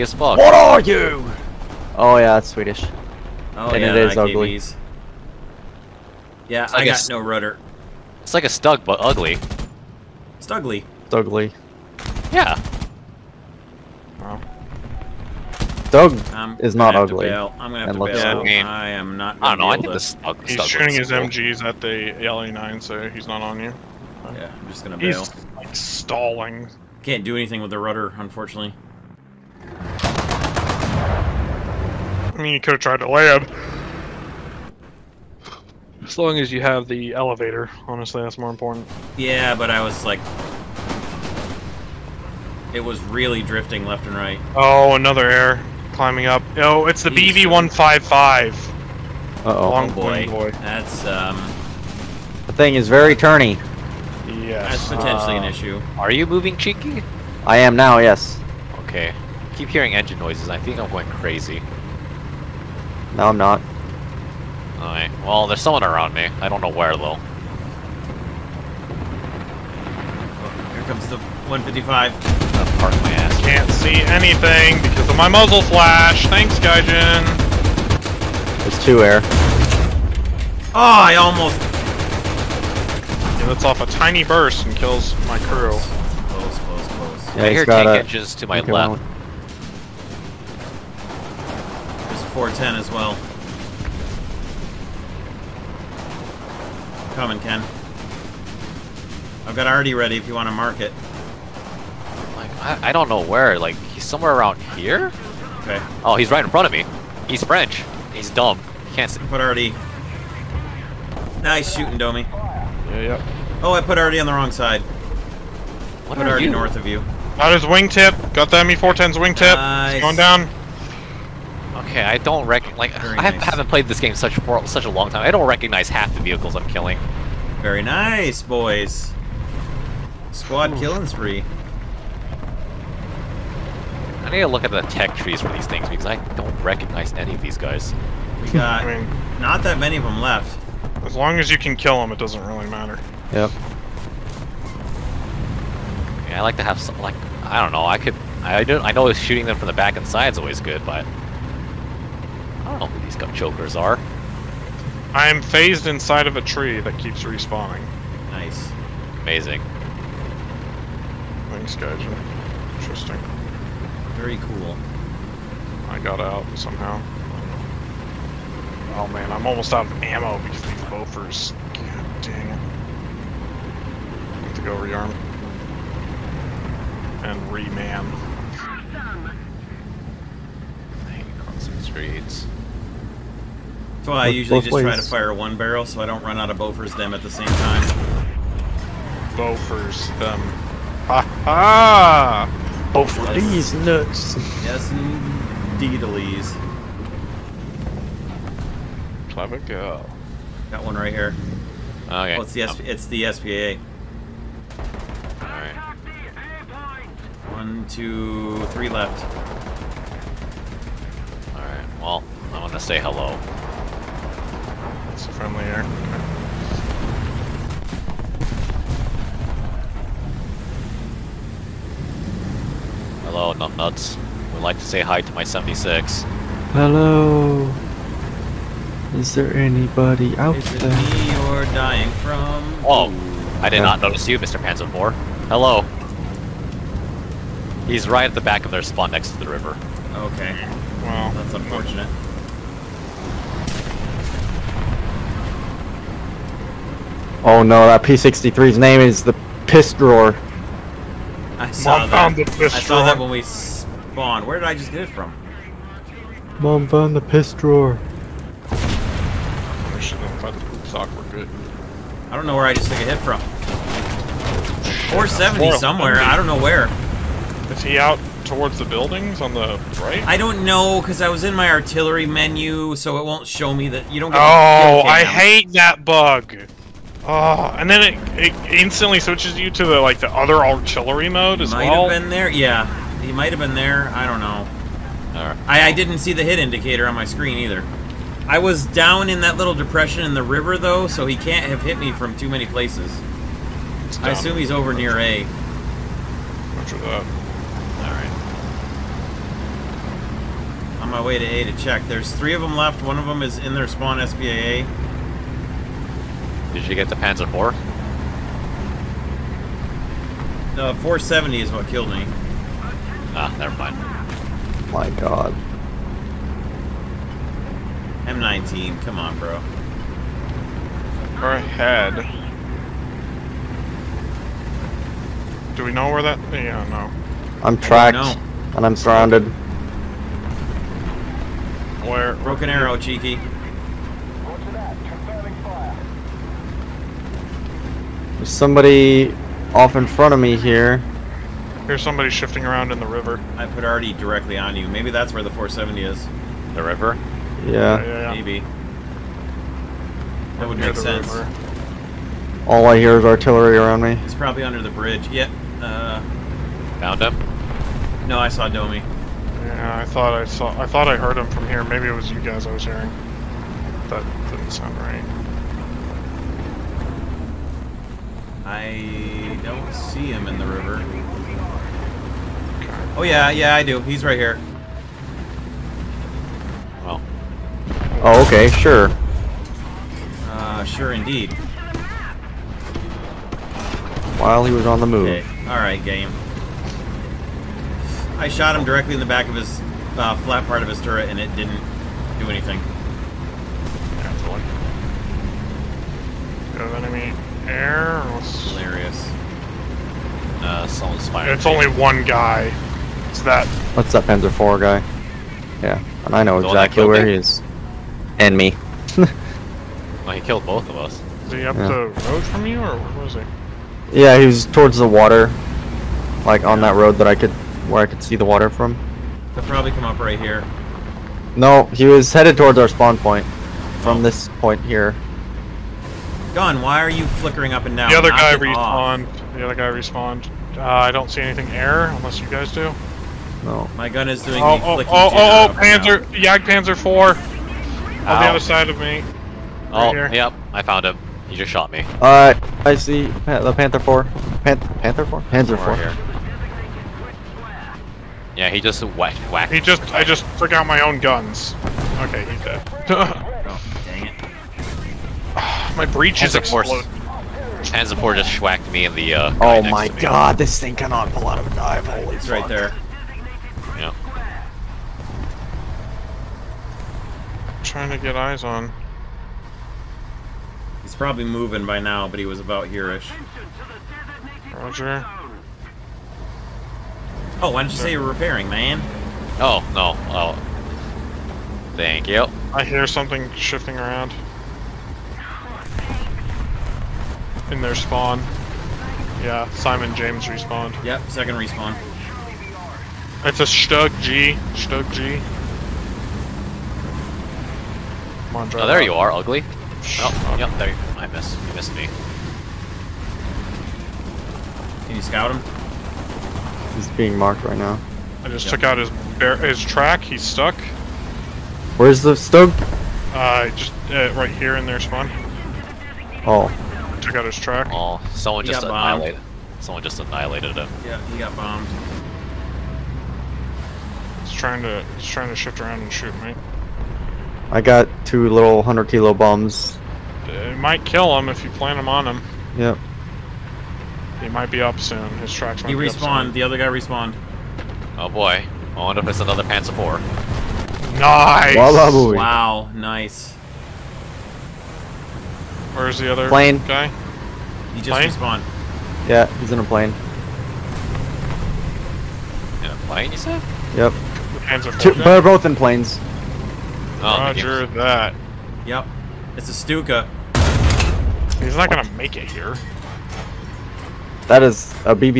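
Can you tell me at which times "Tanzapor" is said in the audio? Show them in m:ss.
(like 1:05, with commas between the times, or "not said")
7:37.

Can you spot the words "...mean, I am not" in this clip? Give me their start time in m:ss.
0:18.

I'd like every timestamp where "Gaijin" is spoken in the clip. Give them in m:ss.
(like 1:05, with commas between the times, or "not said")
1:16.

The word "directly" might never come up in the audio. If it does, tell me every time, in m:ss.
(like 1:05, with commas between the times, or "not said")
5:44, 6:28.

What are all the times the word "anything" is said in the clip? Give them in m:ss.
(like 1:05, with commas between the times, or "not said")
0:27, 1:14, 6:32, 7:11.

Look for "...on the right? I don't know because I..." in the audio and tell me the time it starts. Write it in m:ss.
4:29.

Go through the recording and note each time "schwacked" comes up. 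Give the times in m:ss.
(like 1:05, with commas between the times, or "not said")
7:38.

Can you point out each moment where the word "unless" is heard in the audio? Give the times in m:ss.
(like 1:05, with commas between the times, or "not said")
7:12.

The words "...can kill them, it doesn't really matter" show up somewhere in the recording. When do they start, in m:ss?
2:21.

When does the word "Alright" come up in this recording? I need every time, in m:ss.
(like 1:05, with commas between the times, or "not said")
1:04, 3:31, 7:22.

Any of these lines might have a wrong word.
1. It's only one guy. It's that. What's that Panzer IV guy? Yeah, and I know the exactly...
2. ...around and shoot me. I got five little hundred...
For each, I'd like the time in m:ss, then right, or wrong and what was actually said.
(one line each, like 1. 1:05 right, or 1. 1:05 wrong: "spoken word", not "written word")
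1. 6:41 right
2. 8:45 wrong: "two", not "five".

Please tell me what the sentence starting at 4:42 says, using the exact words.
Yeah, he might have been there.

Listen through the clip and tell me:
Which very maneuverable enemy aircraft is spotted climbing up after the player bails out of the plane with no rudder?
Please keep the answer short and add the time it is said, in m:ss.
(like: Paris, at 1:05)
BV-155, at 0:47.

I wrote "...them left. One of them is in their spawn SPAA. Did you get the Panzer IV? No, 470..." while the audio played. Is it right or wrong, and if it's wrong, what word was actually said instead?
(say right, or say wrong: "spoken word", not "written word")
right.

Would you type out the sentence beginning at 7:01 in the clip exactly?
No, he was headed towards our spawn point.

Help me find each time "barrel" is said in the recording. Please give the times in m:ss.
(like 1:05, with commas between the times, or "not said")
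3:05.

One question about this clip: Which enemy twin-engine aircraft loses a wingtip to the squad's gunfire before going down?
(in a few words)
ME410.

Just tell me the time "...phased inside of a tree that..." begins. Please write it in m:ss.
2:35.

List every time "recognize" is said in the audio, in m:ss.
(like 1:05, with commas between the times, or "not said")
2:05, 2:16.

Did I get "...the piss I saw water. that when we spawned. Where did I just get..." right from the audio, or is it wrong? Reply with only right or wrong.
wrong.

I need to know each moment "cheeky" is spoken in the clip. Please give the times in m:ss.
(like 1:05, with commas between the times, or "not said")
0:56, 5:32.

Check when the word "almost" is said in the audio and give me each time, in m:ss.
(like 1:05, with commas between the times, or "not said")
1:21, 2:49.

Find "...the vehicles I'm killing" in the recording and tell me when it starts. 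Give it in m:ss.
2:06.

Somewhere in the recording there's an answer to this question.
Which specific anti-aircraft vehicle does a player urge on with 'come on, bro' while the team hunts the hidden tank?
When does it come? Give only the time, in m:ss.
5:18.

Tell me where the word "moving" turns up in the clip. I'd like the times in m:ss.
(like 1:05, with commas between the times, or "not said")
0:56, 7:51.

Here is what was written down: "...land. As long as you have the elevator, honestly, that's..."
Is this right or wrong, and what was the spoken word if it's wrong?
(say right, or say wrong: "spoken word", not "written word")
right.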